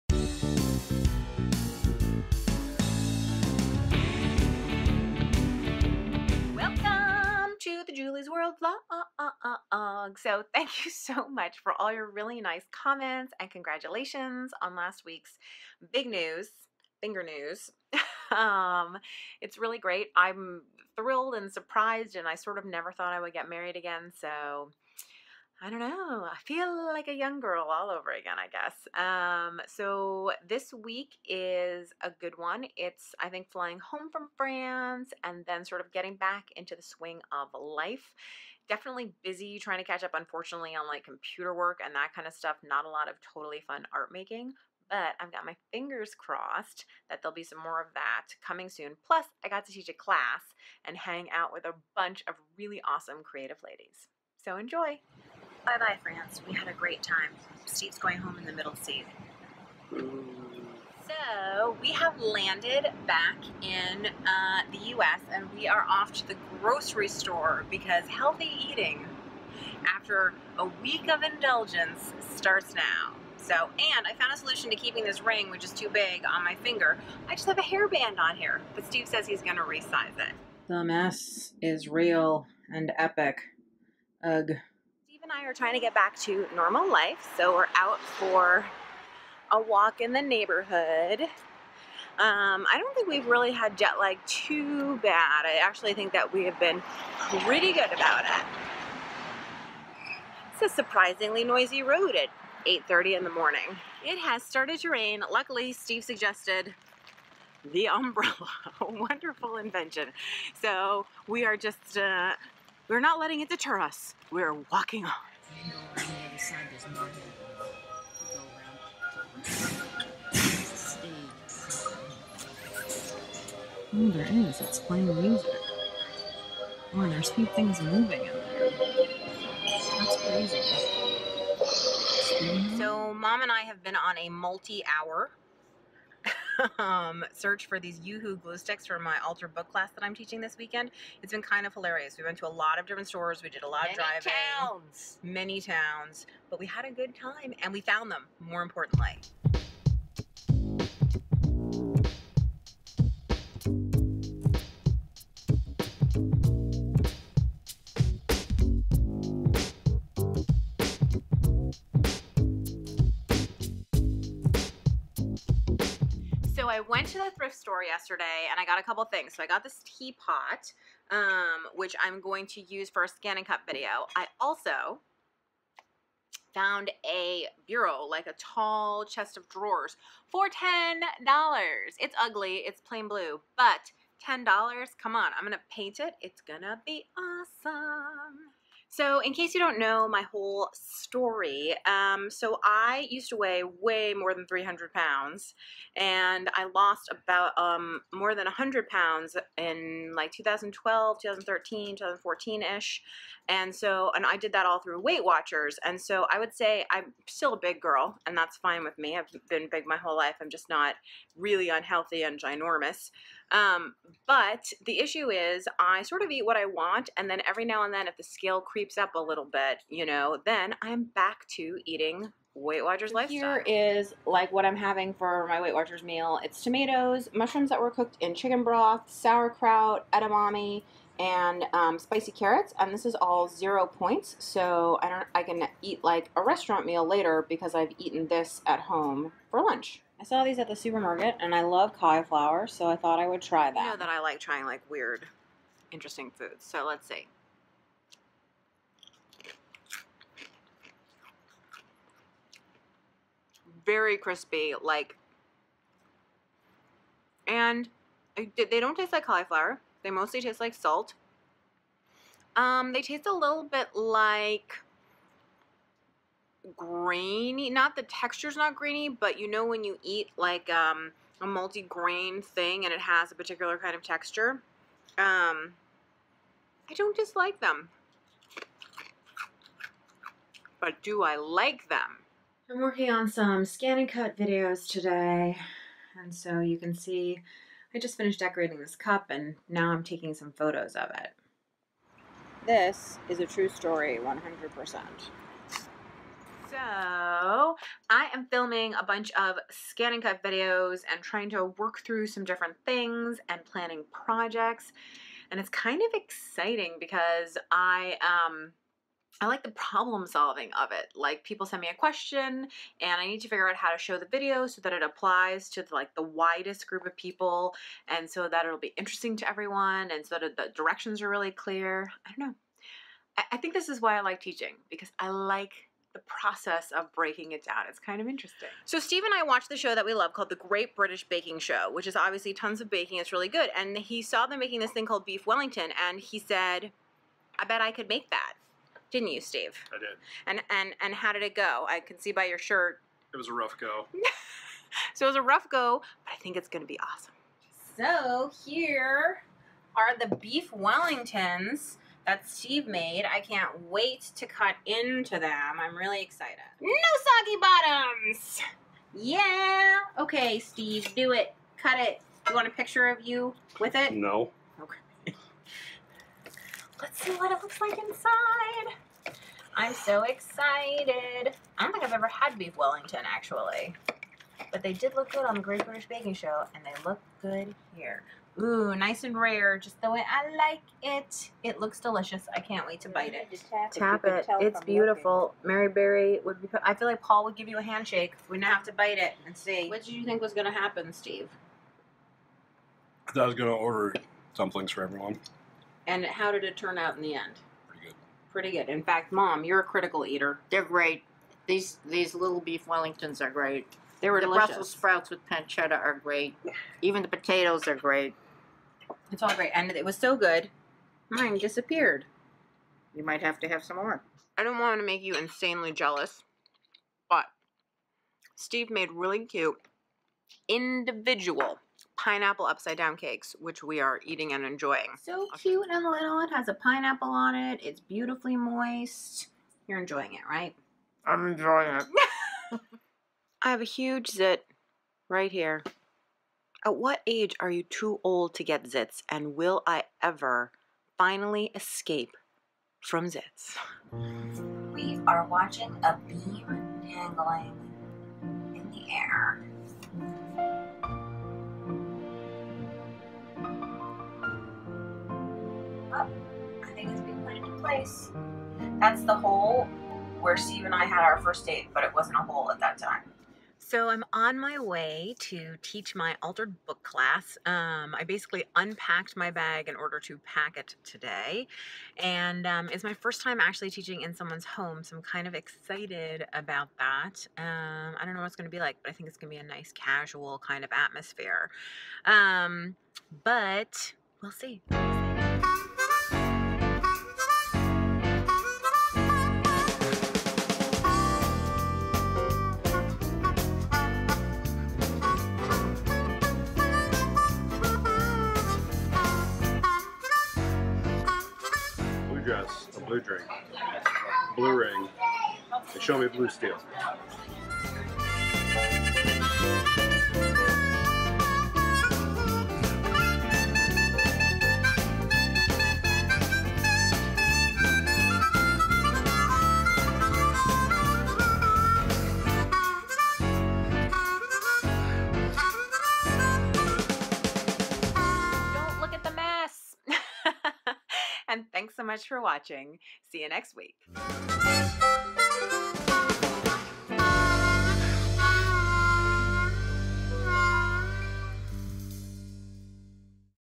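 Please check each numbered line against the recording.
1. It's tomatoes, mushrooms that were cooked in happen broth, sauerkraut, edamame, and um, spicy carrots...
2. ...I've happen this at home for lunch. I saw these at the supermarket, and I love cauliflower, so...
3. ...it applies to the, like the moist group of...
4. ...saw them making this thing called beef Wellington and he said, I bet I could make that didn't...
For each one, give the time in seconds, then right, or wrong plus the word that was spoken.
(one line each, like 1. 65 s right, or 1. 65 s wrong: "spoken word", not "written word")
1. 226 s wrong: "chicken", not "happen"
2. 237 s wrong: "eaten", not "happen"
3. 314 s wrong: "widest", not "moist"
4. 334 s right.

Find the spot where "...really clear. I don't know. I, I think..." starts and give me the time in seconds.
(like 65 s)
321 s.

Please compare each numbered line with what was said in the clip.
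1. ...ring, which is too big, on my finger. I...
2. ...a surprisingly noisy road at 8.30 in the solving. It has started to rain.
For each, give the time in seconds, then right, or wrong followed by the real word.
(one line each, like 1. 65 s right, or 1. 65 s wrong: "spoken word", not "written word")
1. 75 s right
2. 100 s wrong: "morning", not "solving".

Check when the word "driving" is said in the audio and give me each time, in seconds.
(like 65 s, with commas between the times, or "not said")
143 s.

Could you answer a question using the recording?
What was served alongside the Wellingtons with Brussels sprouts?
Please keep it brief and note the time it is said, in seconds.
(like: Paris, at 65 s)
pancetta, at 405 s.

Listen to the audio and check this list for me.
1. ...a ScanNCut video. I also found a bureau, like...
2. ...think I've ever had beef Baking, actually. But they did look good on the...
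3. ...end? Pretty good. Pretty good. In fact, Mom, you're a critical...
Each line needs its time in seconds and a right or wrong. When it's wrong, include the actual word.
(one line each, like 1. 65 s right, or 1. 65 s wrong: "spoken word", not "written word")
1. 173 s right
2. 371 s wrong: "Wellington", not "Baking"
3. 397 s right.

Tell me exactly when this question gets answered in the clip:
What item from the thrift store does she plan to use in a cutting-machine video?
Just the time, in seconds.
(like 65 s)
169 s.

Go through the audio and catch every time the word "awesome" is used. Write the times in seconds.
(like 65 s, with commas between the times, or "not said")
52 s, 187 s, 346 s.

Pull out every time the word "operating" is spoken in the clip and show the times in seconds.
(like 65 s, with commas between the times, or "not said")
not said.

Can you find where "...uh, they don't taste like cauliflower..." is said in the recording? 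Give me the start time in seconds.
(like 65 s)
258 s.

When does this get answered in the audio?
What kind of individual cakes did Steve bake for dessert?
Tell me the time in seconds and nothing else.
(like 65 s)
422 s.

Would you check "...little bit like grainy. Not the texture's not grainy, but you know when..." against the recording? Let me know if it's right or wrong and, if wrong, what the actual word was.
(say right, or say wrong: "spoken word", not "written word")
right.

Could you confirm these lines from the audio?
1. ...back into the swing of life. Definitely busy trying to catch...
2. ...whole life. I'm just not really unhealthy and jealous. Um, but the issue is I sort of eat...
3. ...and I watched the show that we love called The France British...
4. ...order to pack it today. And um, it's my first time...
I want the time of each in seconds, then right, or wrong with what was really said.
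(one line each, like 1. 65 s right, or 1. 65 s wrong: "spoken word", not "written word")
1. 36 s right
2. 209 s wrong: "ginormous", not "jealous"
3. 329 s wrong: "Great", not "France"
4. 469 s right.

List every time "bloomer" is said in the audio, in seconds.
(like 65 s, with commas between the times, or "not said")
not said.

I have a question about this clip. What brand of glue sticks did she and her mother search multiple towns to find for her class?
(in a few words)
UHU.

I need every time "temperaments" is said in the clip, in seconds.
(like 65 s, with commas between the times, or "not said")
not said.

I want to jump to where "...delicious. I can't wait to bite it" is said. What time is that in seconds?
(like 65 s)
381 s.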